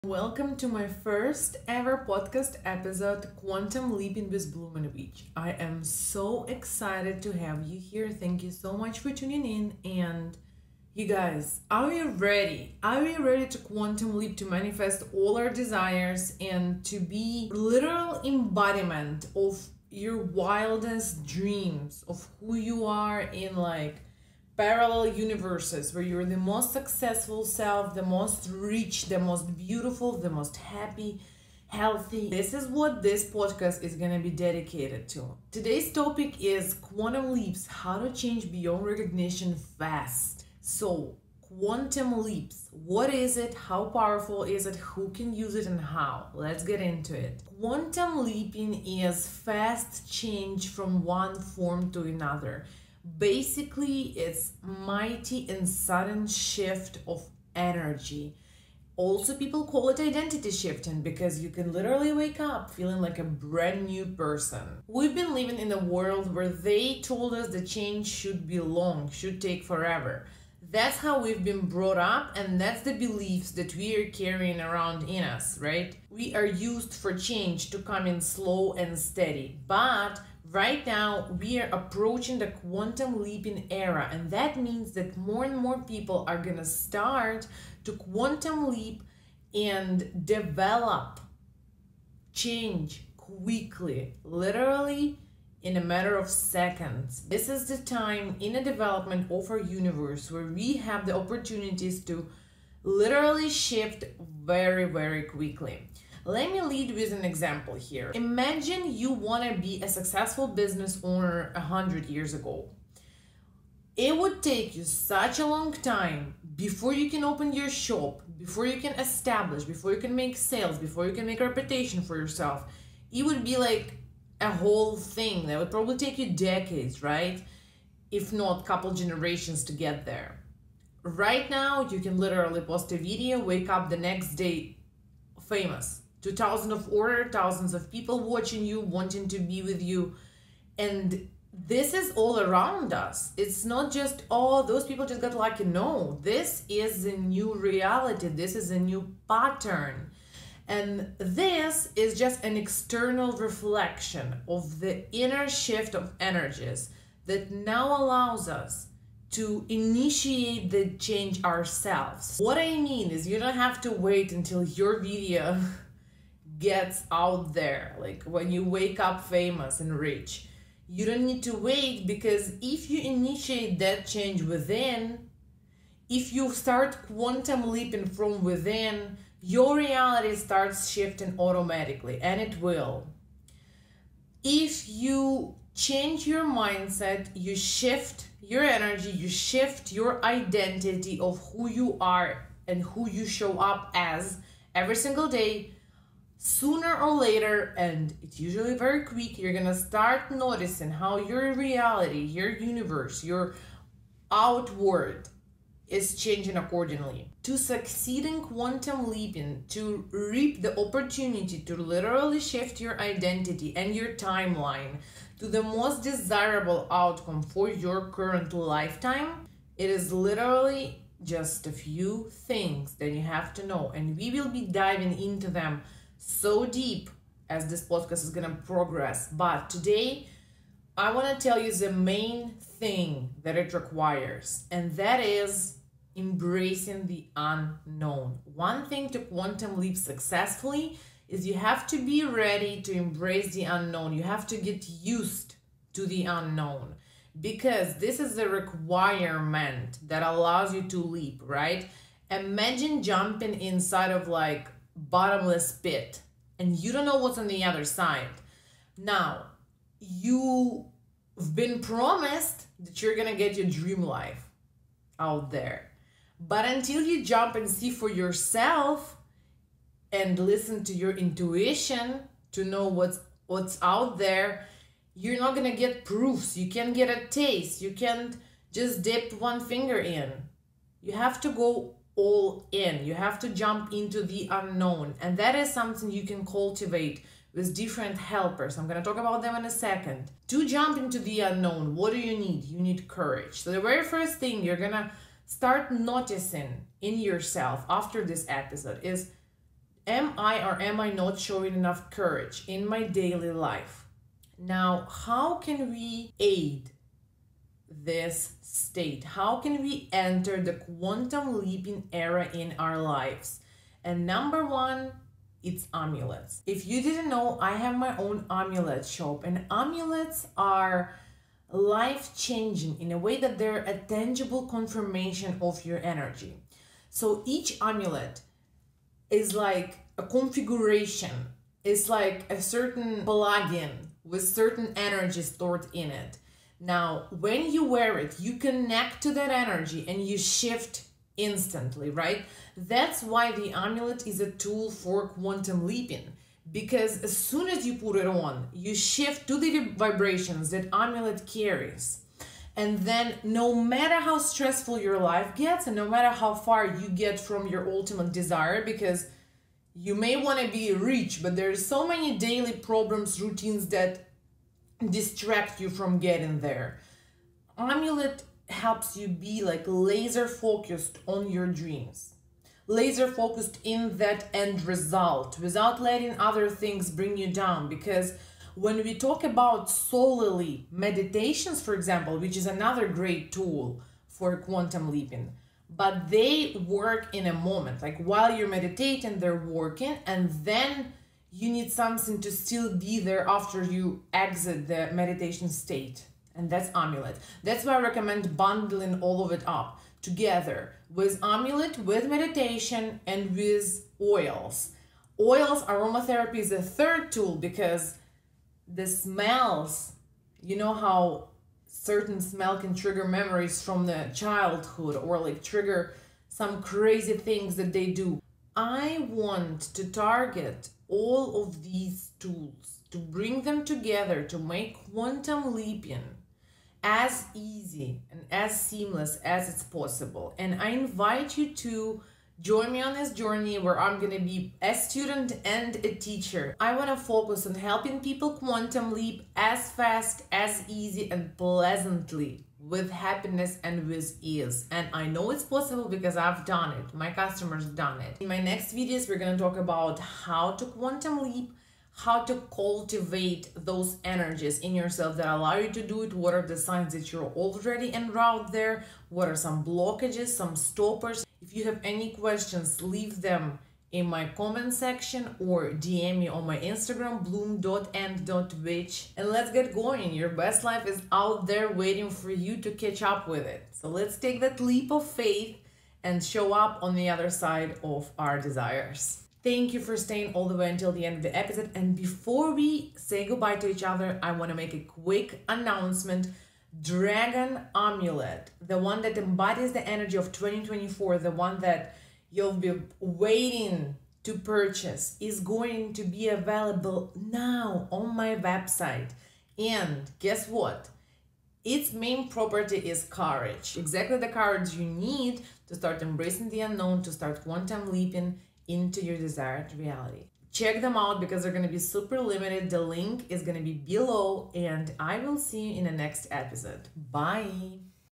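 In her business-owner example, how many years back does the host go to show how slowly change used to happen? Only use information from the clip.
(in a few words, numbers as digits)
100 years.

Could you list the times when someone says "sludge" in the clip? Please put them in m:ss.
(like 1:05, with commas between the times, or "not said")
not said.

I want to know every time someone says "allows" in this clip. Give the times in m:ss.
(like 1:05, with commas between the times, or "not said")
2:38, 4:10, 7:35.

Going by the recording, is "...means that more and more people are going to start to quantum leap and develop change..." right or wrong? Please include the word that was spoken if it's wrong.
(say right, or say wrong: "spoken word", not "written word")
right.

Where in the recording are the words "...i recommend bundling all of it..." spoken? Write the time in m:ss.
6:37.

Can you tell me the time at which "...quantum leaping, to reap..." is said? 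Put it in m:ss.
3:28.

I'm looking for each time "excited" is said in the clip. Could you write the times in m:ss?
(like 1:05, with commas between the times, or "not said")
0:06.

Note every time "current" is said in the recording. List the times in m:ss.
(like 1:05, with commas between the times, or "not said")
3:38.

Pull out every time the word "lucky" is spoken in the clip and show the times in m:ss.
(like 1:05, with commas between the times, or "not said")
2:25.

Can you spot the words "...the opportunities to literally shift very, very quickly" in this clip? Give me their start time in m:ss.
1:41.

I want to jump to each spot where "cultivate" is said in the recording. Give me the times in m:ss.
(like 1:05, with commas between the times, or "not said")
4:46, 7:32.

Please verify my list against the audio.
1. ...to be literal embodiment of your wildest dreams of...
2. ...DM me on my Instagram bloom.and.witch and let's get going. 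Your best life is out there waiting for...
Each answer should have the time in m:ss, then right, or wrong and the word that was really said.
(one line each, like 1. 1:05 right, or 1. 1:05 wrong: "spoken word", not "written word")
1. 0:16 right
2. 7:45 right.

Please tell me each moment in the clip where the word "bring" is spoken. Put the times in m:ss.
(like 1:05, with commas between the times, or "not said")
6:17, 7:03.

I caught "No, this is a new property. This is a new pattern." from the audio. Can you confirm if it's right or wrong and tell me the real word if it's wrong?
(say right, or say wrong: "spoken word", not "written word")
wrong: "reality", not "property".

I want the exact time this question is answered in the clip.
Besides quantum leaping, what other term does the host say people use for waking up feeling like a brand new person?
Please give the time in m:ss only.
0:59.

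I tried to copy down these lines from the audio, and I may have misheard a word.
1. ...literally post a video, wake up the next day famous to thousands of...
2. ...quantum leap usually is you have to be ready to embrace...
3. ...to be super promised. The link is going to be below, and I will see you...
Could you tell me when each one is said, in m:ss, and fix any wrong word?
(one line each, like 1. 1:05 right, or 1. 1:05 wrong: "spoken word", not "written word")
1. 2:12 right
2. 3:59 wrong: "successfully", not "usually"
3. 8:31 wrong: "limited", not "promised".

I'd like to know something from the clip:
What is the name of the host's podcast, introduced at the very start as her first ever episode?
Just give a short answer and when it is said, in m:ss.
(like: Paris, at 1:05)
Quantum Leaping with Beach, at 0:03.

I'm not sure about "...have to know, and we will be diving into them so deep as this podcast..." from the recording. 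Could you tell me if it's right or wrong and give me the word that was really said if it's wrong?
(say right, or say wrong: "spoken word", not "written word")
right.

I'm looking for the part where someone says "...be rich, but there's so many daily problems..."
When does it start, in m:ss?
6:00.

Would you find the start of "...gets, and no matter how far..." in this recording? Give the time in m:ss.
5:55.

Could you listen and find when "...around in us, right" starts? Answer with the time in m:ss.
1:14.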